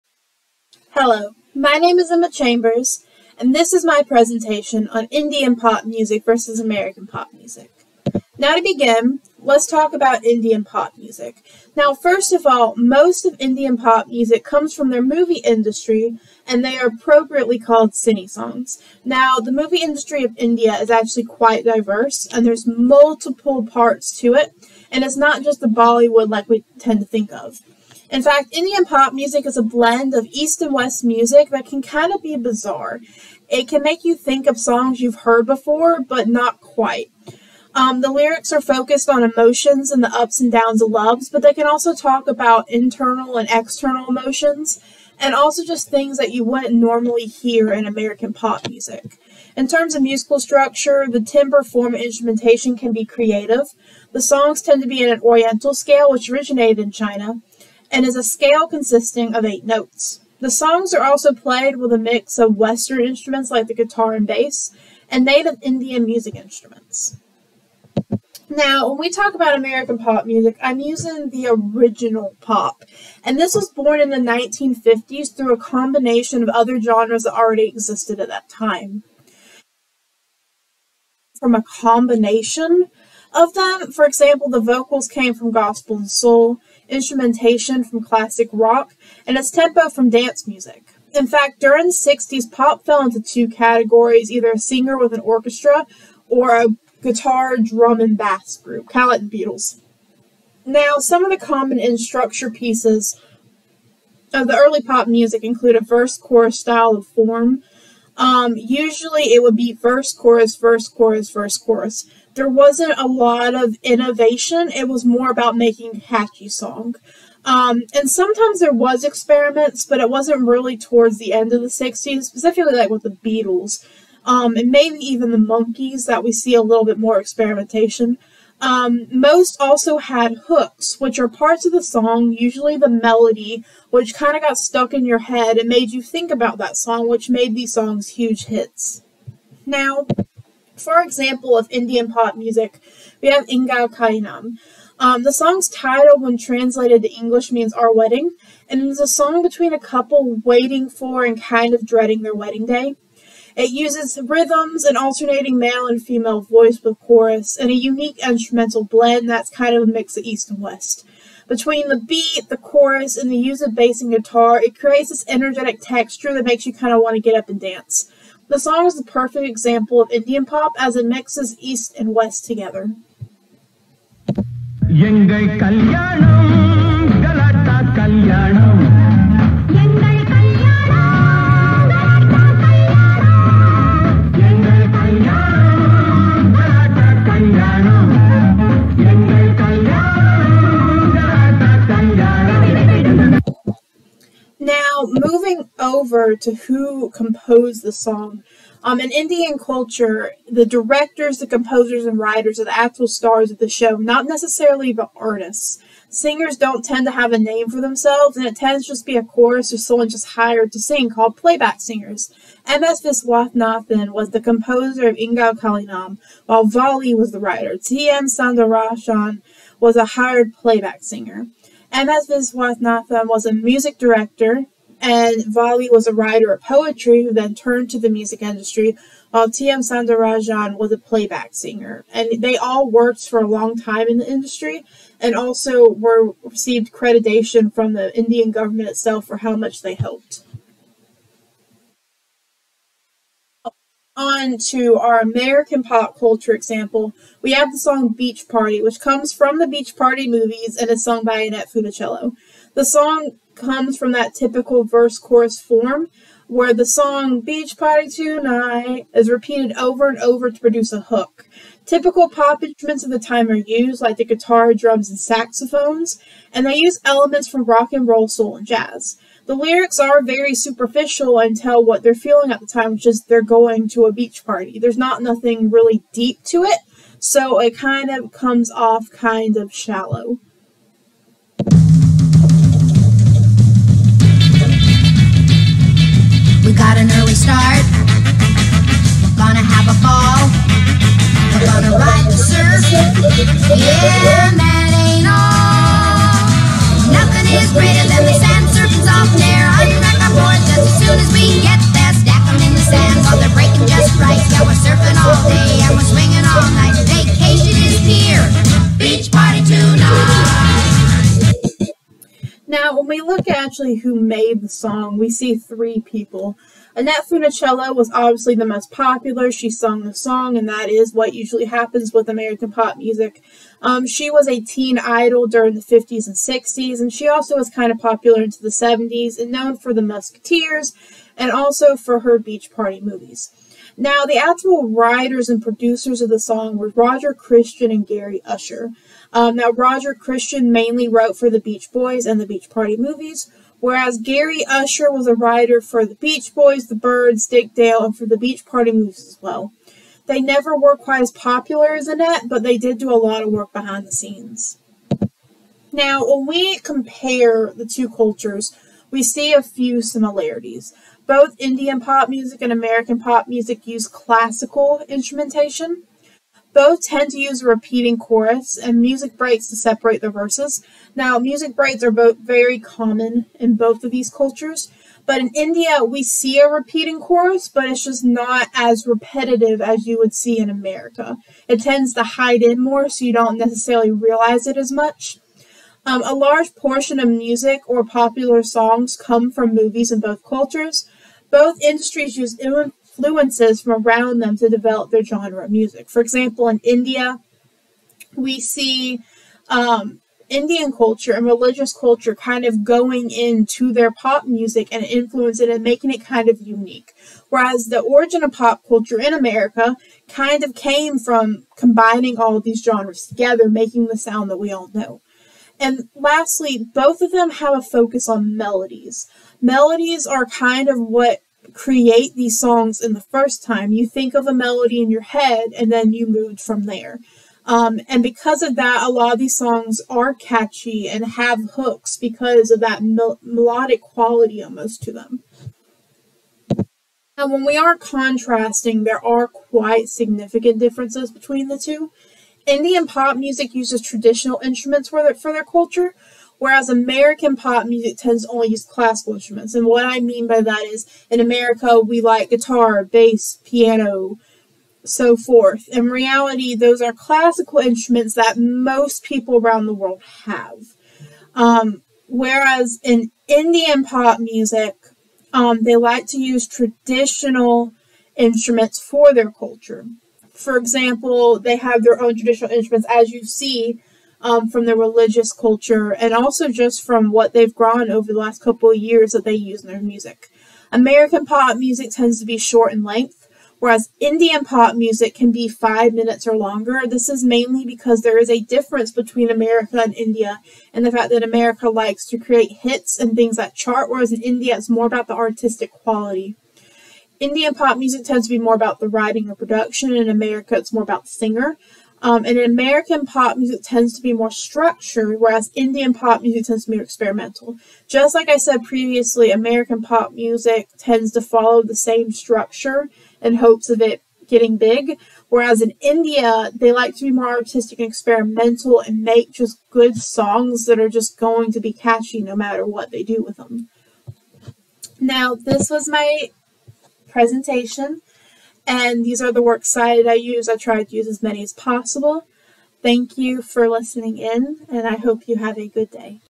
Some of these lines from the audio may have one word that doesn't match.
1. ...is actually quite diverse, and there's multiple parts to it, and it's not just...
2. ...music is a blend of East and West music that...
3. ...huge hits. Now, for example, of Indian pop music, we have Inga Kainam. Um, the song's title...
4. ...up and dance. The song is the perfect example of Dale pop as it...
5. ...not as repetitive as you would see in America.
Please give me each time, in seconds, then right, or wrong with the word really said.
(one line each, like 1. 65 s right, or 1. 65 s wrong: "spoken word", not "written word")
1. 20 s right
2. 29 s right
3. 138 s right
4. 167 s wrong: "Indian", not "Dale"
5. 378 s right.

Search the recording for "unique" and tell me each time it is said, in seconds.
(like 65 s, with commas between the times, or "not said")
157 s, 406 s.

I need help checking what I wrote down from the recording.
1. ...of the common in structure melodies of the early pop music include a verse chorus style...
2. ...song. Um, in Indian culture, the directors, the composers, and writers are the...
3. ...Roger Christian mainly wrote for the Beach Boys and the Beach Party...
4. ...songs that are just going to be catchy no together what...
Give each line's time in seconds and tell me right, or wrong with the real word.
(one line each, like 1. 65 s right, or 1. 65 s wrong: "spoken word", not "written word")
1. 101 s wrong: "pieces", not "melodies"
2. 197 s right
3. 339 s right
4. 520 s wrong: "matter", not "together".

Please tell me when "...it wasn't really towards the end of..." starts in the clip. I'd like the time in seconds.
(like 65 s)
119 s.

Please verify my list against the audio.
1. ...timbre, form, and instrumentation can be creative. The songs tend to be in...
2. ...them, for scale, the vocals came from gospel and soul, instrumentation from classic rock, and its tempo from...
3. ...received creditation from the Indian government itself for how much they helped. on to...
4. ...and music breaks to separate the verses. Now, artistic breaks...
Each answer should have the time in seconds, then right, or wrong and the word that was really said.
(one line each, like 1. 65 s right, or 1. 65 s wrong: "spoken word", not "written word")
1. 51 s right
2. 83 s wrong: "example", not "scale"
3. 236 s right
4. 368 s wrong: "music", not "artistic".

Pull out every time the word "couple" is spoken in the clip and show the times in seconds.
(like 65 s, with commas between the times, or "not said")
149 s, 478 s.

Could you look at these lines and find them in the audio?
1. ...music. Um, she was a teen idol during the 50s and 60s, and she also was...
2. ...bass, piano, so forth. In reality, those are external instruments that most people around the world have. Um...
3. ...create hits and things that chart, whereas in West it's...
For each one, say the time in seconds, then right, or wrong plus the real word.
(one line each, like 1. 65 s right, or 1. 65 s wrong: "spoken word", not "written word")
1. 322 s right
2. 453 s wrong: "classical", not "external"
3. 492 s wrong: "India", not "West".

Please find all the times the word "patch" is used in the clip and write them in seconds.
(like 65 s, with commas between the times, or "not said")
not said.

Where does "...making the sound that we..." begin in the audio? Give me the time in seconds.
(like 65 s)
413 s.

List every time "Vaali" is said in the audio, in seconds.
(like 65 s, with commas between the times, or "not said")
216 s, 225 s.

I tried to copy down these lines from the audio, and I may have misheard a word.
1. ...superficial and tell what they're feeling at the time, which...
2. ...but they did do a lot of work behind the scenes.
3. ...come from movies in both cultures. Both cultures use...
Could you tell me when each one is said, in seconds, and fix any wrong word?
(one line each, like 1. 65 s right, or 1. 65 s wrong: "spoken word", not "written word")
1. 270 s right
2. 352 s right
3. 389 s wrong: "industries", not "cultures".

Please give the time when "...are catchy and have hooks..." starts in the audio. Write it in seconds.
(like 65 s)
430 s.